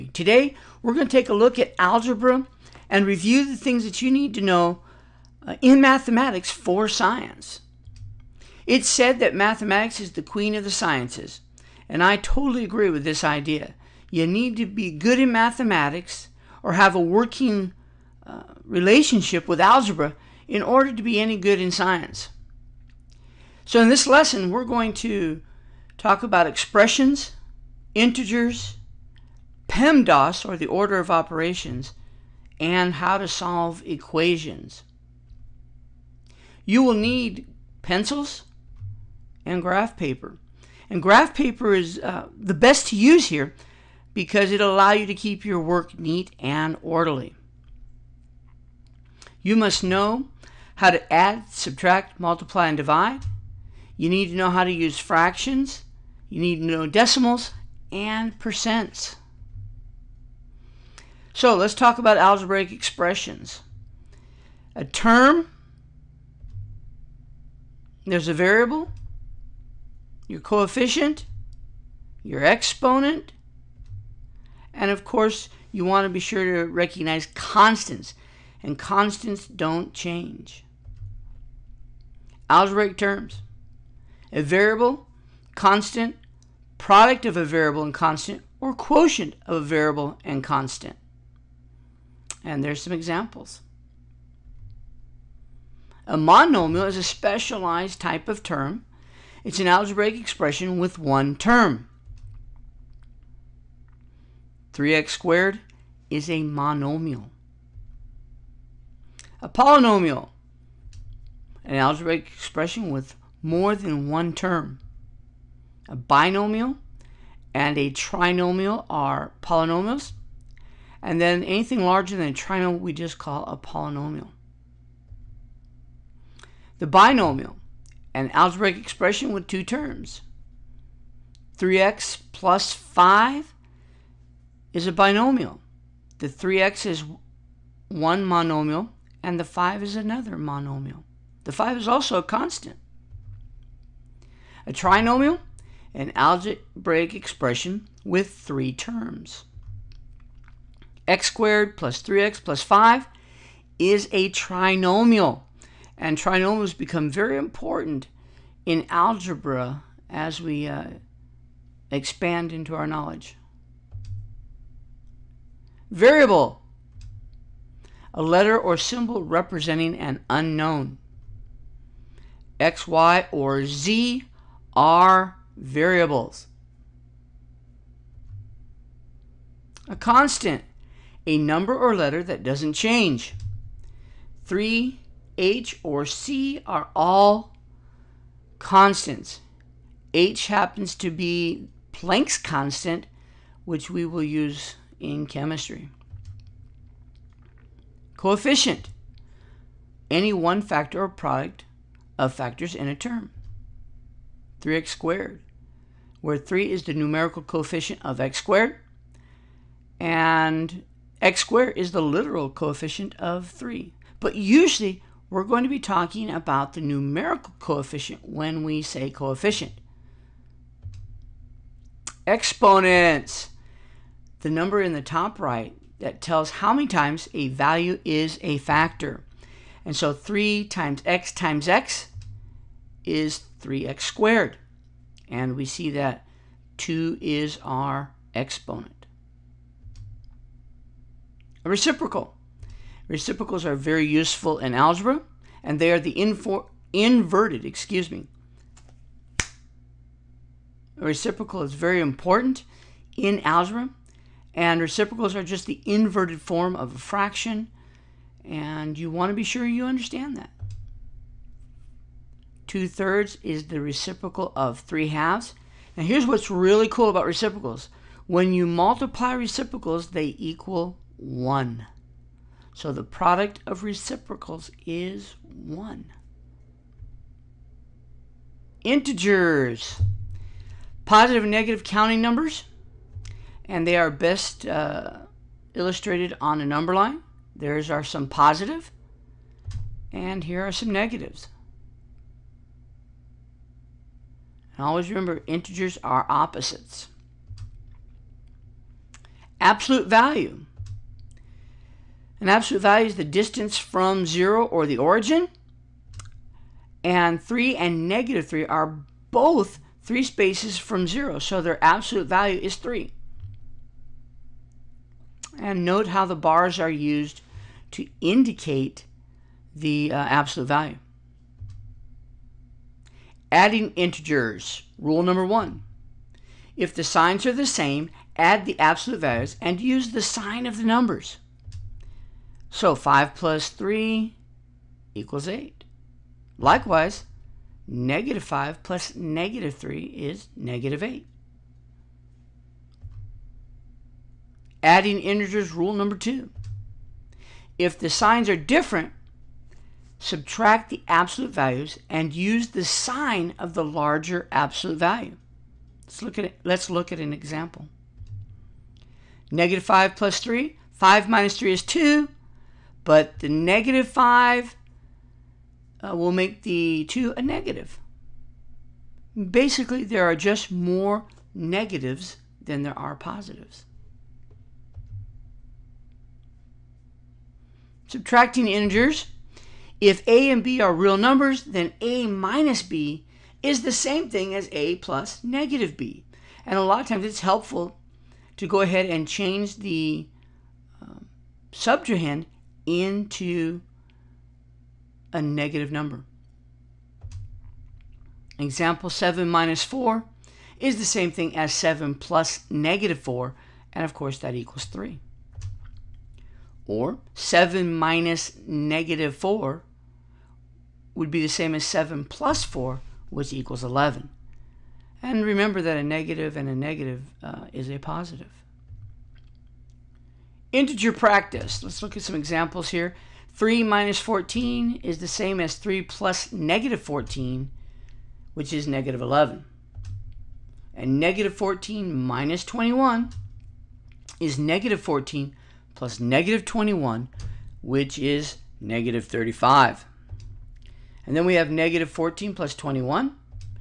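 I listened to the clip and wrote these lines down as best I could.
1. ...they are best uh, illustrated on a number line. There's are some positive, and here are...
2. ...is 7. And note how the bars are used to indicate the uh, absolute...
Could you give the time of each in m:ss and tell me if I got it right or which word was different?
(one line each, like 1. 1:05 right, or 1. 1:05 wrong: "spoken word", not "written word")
1. 4:43 right
2. 5:12 wrong: "3", not "7".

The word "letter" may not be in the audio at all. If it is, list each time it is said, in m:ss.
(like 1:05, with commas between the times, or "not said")
2:48, 3:01.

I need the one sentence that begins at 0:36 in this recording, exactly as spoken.
You will need pencils and graph paper.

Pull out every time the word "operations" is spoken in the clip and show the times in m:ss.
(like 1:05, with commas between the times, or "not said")
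0:31.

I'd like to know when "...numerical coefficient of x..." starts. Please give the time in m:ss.
3:26.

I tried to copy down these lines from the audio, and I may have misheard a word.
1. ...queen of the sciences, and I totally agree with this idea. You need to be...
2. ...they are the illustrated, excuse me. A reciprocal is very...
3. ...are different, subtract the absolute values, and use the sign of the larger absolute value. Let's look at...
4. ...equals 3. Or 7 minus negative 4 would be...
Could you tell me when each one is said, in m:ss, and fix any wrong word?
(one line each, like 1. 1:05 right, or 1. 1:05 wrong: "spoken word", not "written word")
1. 0:10 right
2. 4:05 wrong: "inverted", not "illustrated"
3. 5:48 right
4. 6:44 right.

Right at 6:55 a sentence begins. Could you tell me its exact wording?
And remember that a negative and a negative uh, is a positive.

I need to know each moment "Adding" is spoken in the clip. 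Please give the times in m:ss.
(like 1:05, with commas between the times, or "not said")
5:23, 5:44.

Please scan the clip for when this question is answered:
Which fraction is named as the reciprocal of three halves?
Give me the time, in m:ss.
4:22.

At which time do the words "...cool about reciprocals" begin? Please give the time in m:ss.
4:26.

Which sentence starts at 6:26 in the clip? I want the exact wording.
And a lot of times it's helpful to go ahead and change the um, subtrahend into a negative number.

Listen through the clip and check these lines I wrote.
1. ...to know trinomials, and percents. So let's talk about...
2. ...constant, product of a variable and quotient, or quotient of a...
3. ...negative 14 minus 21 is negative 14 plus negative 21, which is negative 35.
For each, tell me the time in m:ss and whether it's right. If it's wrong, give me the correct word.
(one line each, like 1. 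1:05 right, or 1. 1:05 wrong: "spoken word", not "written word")
1. 0:56 wrong: "decimals", not "trinomials"
2. 1:25 wrong: "constant", not "quotient"
3. 7:11 right.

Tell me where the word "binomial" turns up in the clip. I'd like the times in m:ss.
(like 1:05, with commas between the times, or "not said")
1:55, 2:06, 2:14.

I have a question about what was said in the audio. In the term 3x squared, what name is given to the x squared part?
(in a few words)
literal coefficient.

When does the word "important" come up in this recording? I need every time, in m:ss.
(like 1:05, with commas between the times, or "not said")
2:37, 4:11.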